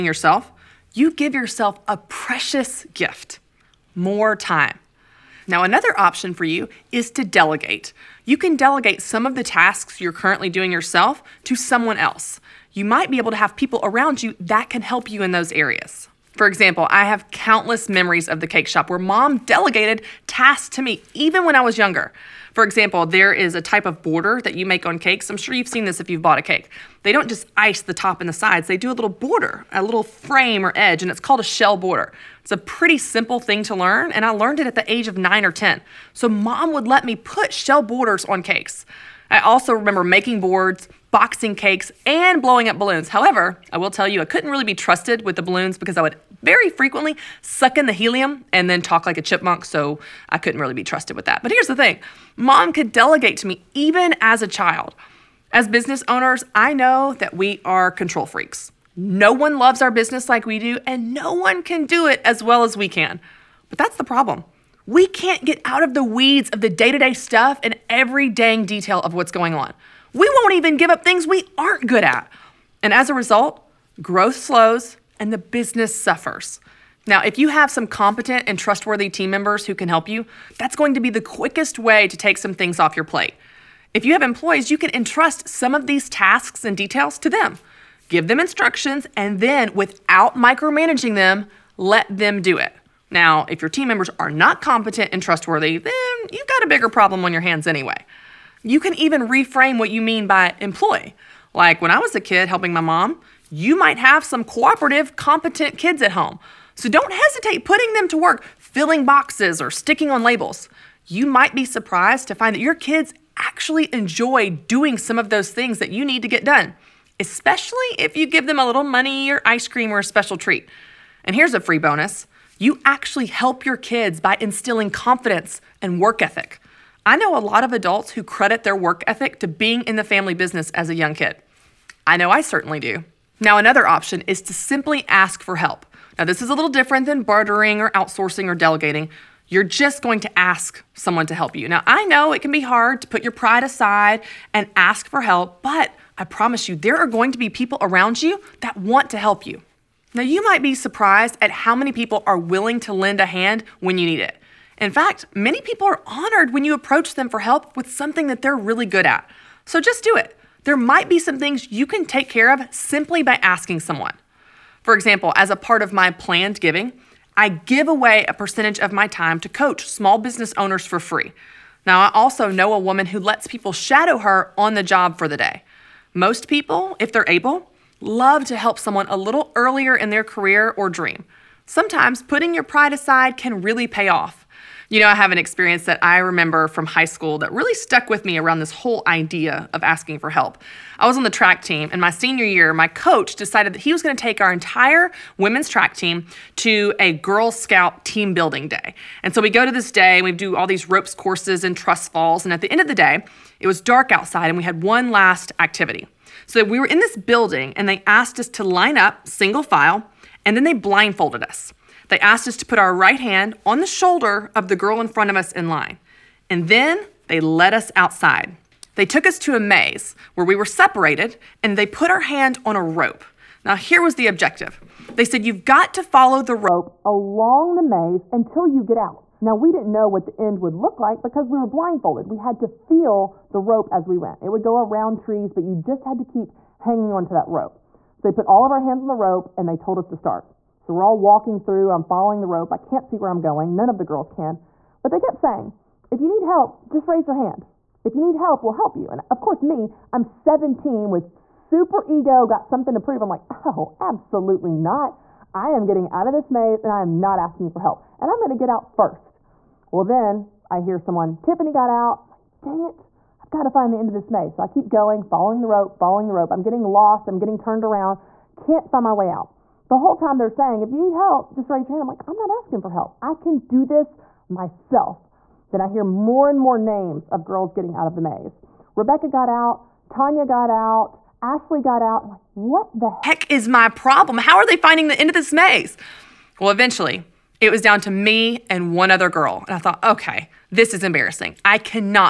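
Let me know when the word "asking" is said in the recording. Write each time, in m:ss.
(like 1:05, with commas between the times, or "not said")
2:43, 3:09, 4:17, 4:32.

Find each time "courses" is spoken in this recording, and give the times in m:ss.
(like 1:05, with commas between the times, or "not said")
3:21, 4:09.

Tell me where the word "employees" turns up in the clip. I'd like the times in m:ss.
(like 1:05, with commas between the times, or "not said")
1:24, 1:40.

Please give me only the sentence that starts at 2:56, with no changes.
Most people, if they're able, love to help someone a little earlier in their career or dream.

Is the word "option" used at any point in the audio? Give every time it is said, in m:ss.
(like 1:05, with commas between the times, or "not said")
0:05, 2:13.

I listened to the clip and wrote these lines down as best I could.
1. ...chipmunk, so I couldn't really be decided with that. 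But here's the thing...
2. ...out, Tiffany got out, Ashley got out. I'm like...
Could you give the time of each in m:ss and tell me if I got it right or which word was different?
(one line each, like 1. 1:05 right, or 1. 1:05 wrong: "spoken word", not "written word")
1. 0:49 wrong: "trusted", not "decided"
2. 4:39 wrong: "Tanya", not "Tiffany".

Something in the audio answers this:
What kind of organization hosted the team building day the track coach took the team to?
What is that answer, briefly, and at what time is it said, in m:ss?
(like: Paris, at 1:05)
Girl Scout, at 3:17.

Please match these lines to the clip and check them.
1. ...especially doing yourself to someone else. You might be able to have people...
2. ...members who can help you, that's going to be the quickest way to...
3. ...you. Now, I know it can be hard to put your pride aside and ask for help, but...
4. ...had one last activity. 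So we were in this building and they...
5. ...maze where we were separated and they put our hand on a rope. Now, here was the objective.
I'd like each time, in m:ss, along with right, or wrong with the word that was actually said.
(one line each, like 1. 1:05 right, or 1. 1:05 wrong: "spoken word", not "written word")
1. 0:10 wrong: "currently", not "especially"
2. 1:19 right
3. 2:21 right
4. 3:24 right
5. 3:39 right.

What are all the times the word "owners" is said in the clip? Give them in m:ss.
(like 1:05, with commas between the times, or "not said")
0:56, 2:50.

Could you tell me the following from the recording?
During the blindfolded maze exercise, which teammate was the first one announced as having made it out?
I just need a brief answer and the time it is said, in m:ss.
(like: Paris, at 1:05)
Tiffany, at 4:21.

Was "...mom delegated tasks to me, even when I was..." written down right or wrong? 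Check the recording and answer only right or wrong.
right.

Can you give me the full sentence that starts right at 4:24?
So I keep going, following the rope, following the rope.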